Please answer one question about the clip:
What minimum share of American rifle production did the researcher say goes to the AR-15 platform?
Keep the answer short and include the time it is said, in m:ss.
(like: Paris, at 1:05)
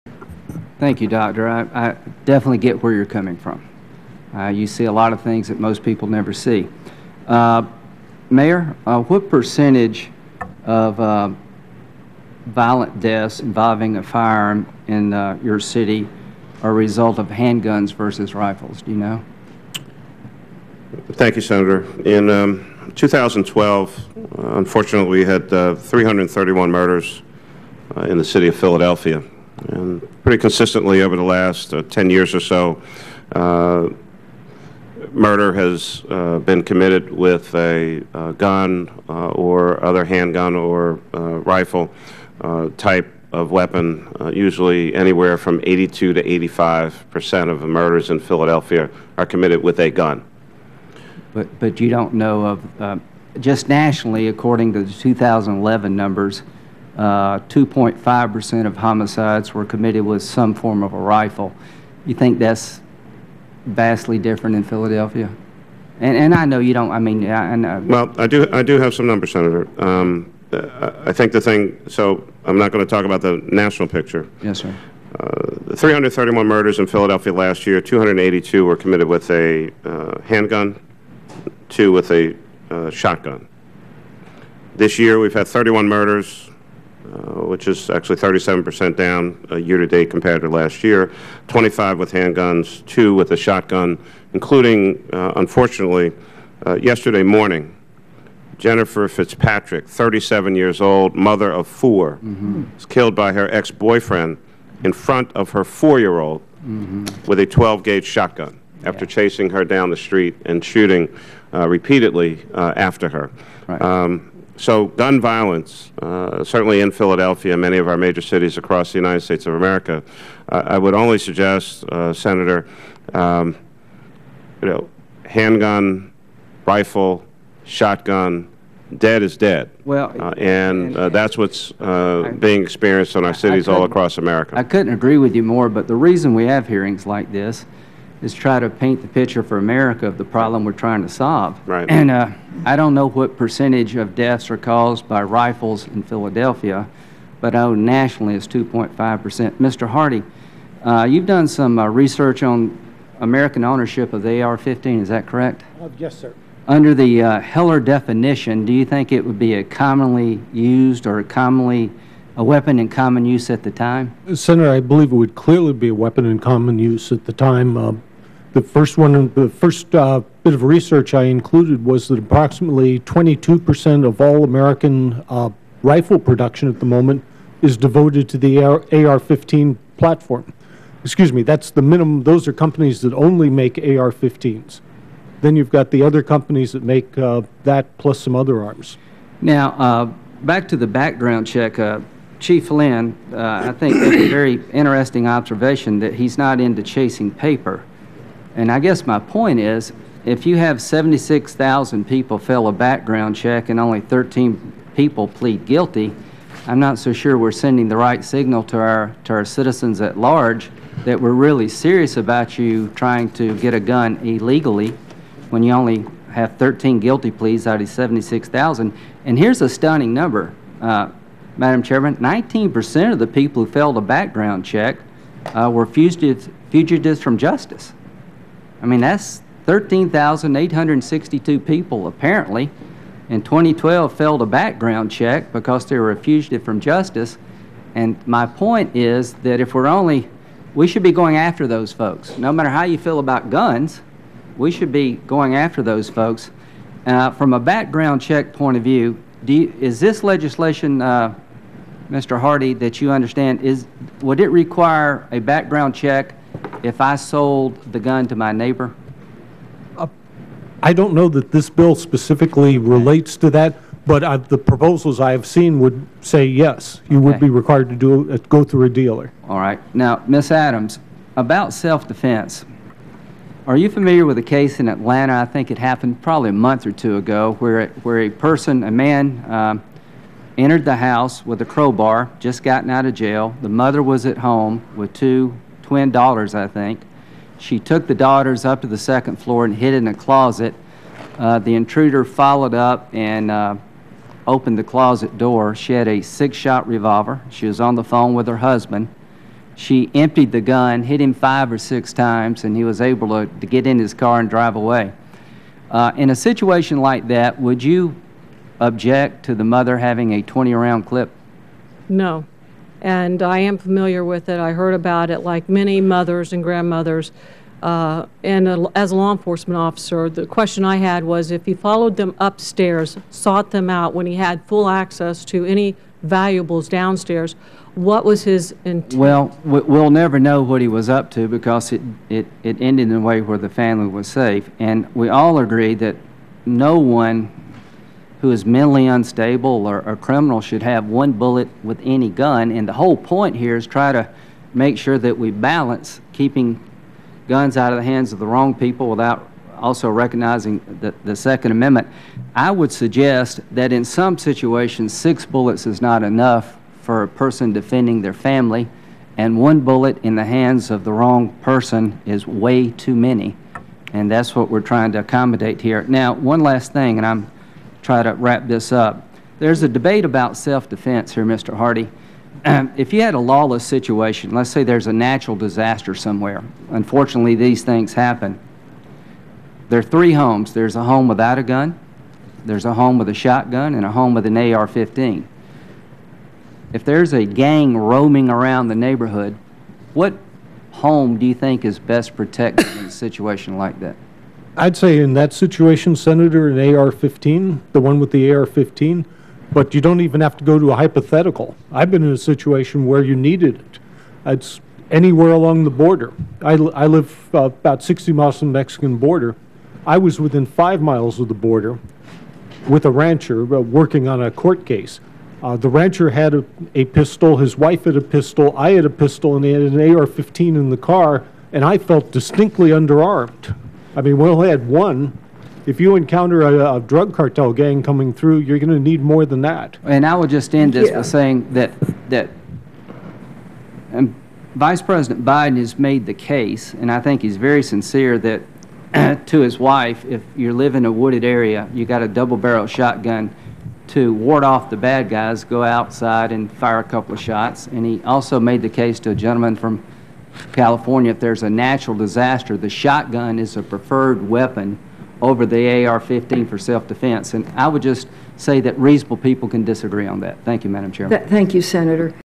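22 percent, at 2:52.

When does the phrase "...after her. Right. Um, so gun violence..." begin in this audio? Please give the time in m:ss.
1:52.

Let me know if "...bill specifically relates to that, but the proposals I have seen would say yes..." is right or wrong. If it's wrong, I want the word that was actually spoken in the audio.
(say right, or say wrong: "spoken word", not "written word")
right.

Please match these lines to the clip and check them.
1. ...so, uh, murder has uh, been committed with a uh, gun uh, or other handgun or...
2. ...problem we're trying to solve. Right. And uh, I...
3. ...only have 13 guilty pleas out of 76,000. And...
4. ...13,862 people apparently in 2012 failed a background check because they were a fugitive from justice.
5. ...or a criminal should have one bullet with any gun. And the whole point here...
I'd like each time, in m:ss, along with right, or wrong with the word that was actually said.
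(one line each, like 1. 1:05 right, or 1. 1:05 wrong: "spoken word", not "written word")
1. 0:32 right
2. 2:20 right
3. 3:35 right
4. 3:49 right
5. 5:39 right.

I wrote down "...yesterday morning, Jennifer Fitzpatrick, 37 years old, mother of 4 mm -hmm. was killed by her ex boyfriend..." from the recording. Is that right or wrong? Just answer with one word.
right.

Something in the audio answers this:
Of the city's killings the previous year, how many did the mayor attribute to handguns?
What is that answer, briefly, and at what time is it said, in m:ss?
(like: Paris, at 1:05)
282, at 1:17.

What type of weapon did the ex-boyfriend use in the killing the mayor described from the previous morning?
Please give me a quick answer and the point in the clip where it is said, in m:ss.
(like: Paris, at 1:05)
12 gauge shotgun, at 1:47.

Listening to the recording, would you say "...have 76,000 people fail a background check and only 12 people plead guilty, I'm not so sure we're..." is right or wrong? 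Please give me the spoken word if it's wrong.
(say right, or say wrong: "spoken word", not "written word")
wrong: "13", not "12".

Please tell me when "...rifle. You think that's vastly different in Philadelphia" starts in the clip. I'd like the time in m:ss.
1:00.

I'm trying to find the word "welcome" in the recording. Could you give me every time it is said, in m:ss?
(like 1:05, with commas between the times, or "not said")
not said.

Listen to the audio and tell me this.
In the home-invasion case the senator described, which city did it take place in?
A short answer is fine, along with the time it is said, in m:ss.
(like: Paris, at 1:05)
Atlanta, at 4:34.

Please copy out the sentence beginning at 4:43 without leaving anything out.
The mother was at home with two twin daughters, I think.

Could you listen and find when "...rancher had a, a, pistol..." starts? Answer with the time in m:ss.
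6:55.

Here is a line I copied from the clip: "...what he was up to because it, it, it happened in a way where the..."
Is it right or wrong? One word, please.
wrong.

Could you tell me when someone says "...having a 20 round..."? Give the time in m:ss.
5:09.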